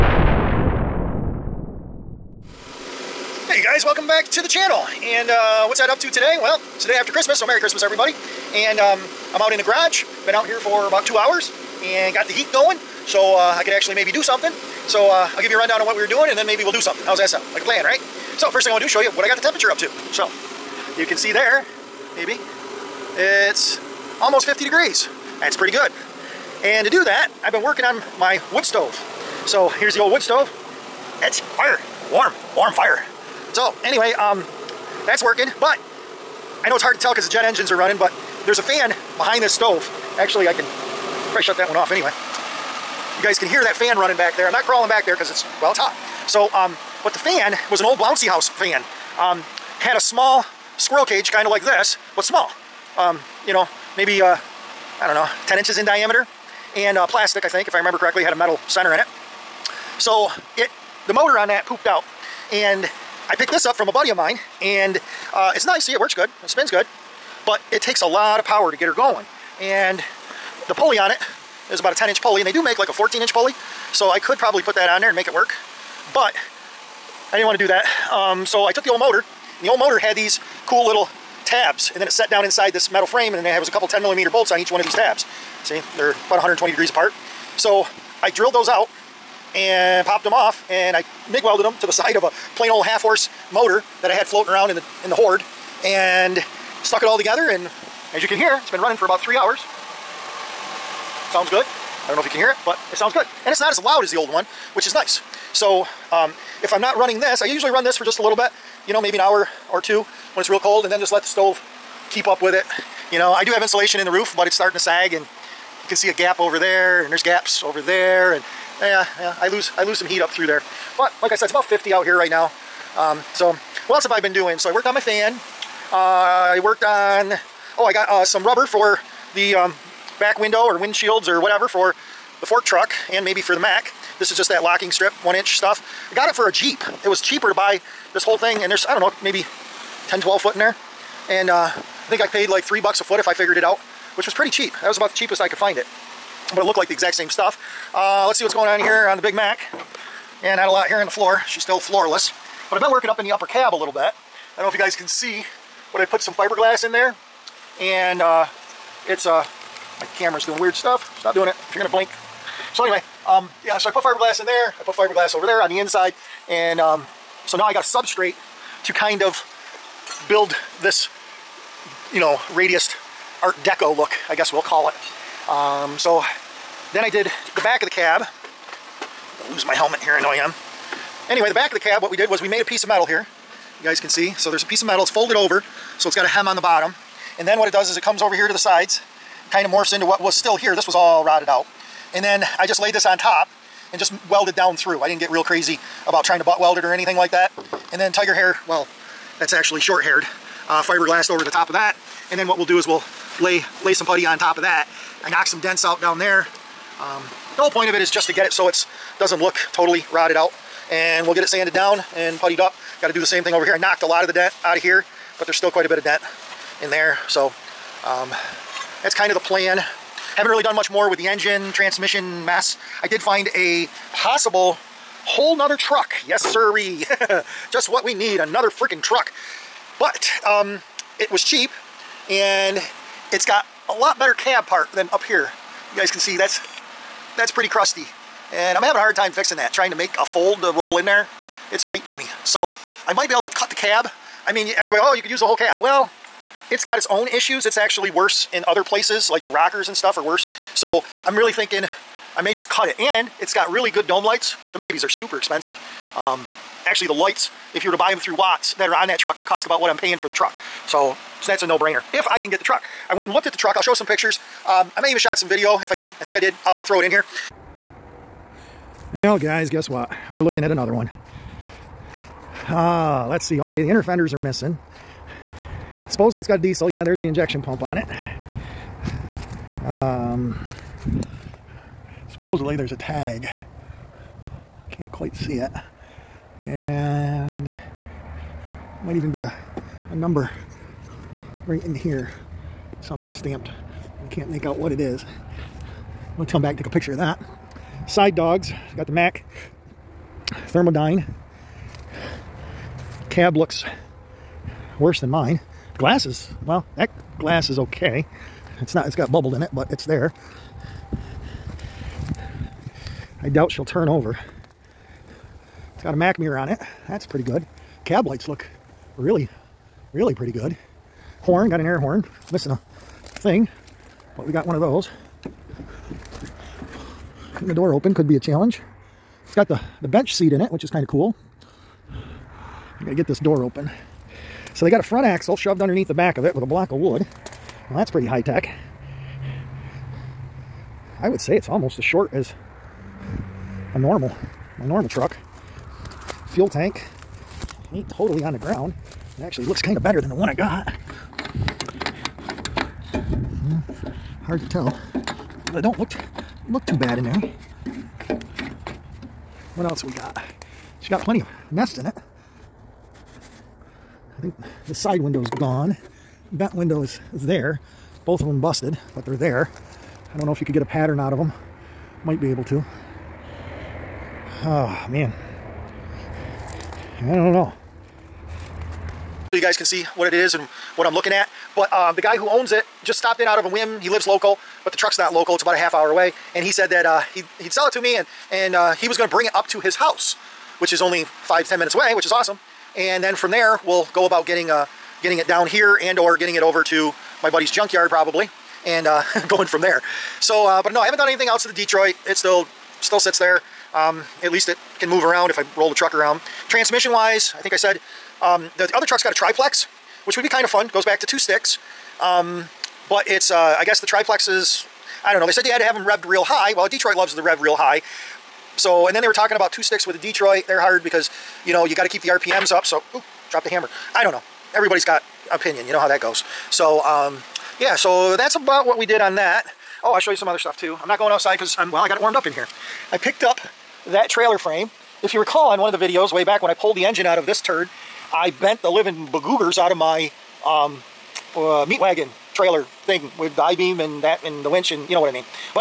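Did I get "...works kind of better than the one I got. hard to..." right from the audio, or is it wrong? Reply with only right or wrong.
wrong.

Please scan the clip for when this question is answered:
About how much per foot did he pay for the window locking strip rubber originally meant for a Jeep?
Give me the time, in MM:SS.
02:22.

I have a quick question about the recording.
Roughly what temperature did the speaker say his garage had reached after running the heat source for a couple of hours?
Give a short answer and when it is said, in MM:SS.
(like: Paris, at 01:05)
50 degrees, at 00:24.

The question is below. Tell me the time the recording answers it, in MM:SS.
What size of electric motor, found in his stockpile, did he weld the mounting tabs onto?
01:32.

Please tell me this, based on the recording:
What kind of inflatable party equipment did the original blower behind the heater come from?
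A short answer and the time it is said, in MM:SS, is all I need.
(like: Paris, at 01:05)
bouncy house, at 00:47.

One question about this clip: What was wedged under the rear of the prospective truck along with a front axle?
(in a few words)
a block of wood.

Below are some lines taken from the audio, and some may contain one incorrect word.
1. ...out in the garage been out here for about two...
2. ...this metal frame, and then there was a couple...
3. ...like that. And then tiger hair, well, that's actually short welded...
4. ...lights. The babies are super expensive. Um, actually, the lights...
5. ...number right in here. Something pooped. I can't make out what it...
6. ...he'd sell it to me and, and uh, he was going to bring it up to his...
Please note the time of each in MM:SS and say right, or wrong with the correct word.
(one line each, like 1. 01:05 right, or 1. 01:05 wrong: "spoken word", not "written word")
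1. 00:09 right
2. 01:22 right
3. 03:17 wrong: "haired", not "welded"
4. 04:14 right
5. 04:50 wrong: "stamped", not "pooped"
6. 06:27 right.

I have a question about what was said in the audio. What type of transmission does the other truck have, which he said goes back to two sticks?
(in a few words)
triplex.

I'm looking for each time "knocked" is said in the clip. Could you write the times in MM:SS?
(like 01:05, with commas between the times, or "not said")
03:25, 03:33.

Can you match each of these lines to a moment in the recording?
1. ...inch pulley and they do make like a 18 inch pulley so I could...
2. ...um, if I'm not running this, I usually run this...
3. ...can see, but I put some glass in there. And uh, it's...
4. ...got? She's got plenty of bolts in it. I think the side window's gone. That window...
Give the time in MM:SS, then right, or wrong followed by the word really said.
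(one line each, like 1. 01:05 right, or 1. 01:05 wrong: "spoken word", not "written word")
1. 01:12 wrong: "14", not "18"
2. 01:46 right
3. 02:34 wrong: "fiberglass", not "glass"
4. 06:00 wrong: "nests", not "bolts".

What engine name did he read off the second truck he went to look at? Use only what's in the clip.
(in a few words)
Mack Thermodyne.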